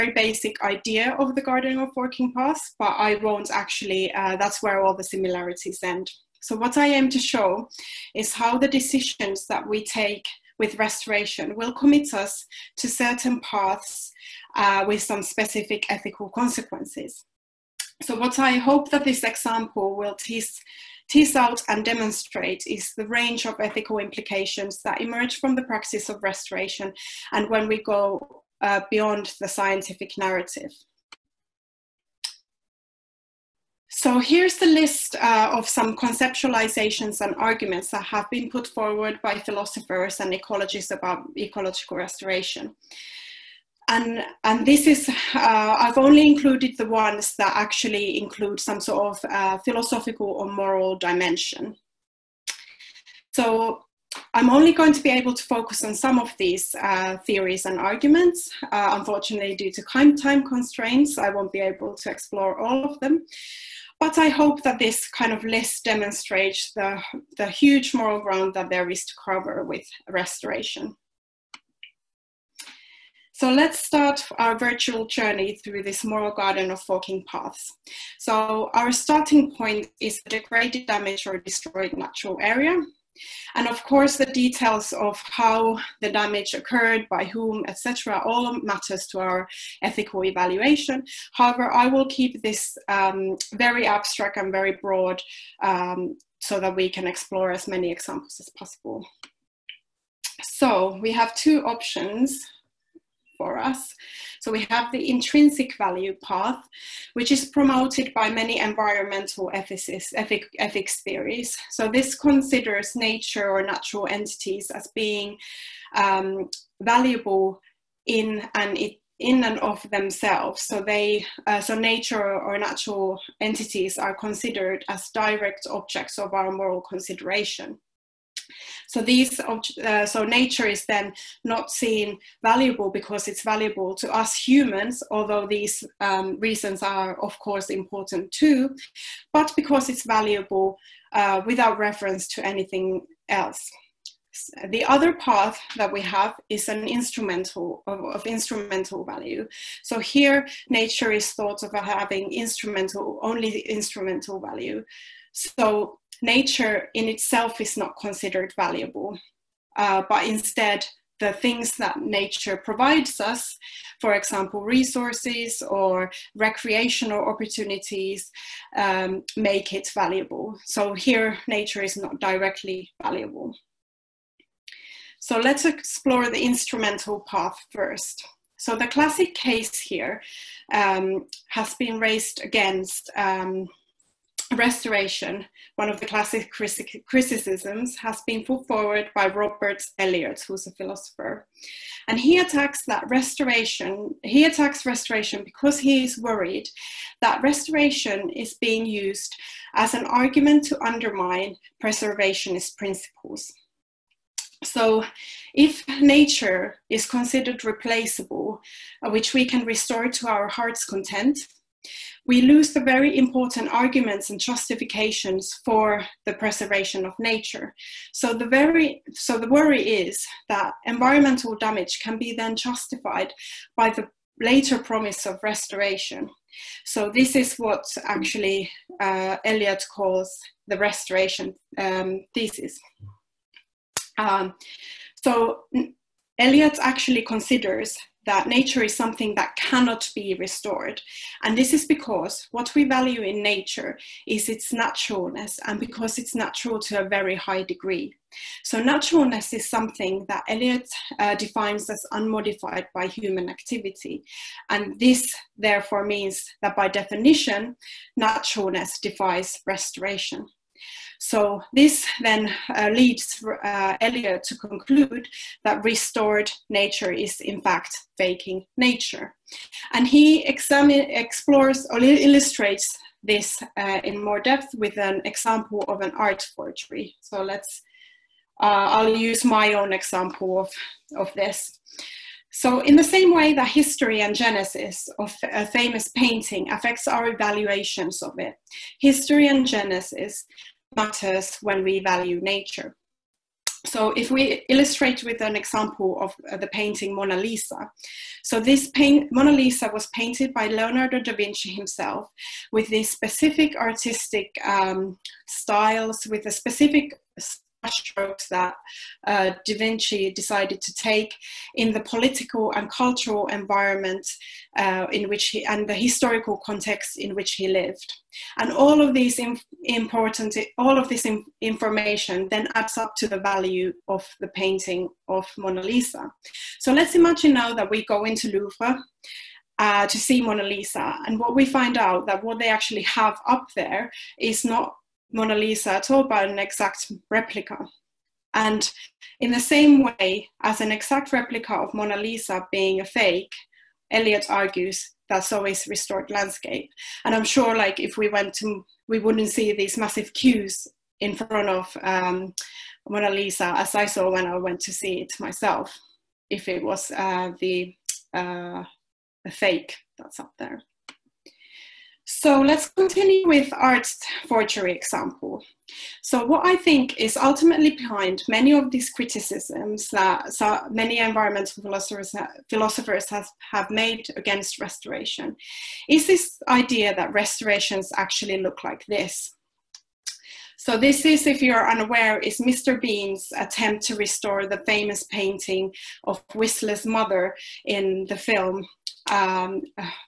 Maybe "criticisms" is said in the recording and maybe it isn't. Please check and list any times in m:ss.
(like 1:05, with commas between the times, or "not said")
3:06, 6:09.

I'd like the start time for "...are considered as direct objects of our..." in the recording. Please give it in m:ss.
2:03.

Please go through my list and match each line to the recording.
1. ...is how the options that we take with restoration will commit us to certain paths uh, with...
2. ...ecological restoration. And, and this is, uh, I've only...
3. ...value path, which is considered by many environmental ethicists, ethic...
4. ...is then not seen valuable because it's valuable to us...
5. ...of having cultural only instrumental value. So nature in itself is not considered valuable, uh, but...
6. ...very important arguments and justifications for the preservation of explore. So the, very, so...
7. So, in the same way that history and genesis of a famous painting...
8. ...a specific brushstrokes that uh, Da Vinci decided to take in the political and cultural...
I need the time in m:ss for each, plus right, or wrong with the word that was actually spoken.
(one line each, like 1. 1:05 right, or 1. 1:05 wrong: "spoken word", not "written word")
1. 0:08 wrong: "decisions", not "options"
2. 0:41 right
3. 1:45 wrong: "promoted", not "considered"
4. 2:10 right
5. 2:31 wrong: "instrumental", not "cultural"
6. 3:32 wrong: "nature", not "explore"
7. 4:42 right
8. 5:06 right.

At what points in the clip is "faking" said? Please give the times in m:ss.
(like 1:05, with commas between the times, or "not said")
4:28.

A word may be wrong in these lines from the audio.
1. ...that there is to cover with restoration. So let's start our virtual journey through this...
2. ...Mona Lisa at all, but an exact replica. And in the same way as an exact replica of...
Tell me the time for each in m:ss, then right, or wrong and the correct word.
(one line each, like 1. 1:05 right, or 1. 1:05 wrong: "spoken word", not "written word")
1. 1:08 right
2. 5:35 right.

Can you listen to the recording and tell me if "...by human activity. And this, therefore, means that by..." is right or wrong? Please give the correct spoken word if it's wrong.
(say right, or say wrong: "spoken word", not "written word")
right.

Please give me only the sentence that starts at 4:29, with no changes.
And he examine, explores or illustrates this uh, in more depth with an example of an art forgery.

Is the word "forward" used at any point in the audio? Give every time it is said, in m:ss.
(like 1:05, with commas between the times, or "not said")
0:38, 3:08.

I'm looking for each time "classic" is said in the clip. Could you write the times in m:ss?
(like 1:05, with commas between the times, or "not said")
2:58, 3:06.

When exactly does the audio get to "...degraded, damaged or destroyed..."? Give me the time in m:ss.
1:20.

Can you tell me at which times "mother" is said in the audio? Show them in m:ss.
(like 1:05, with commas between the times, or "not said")
6:27.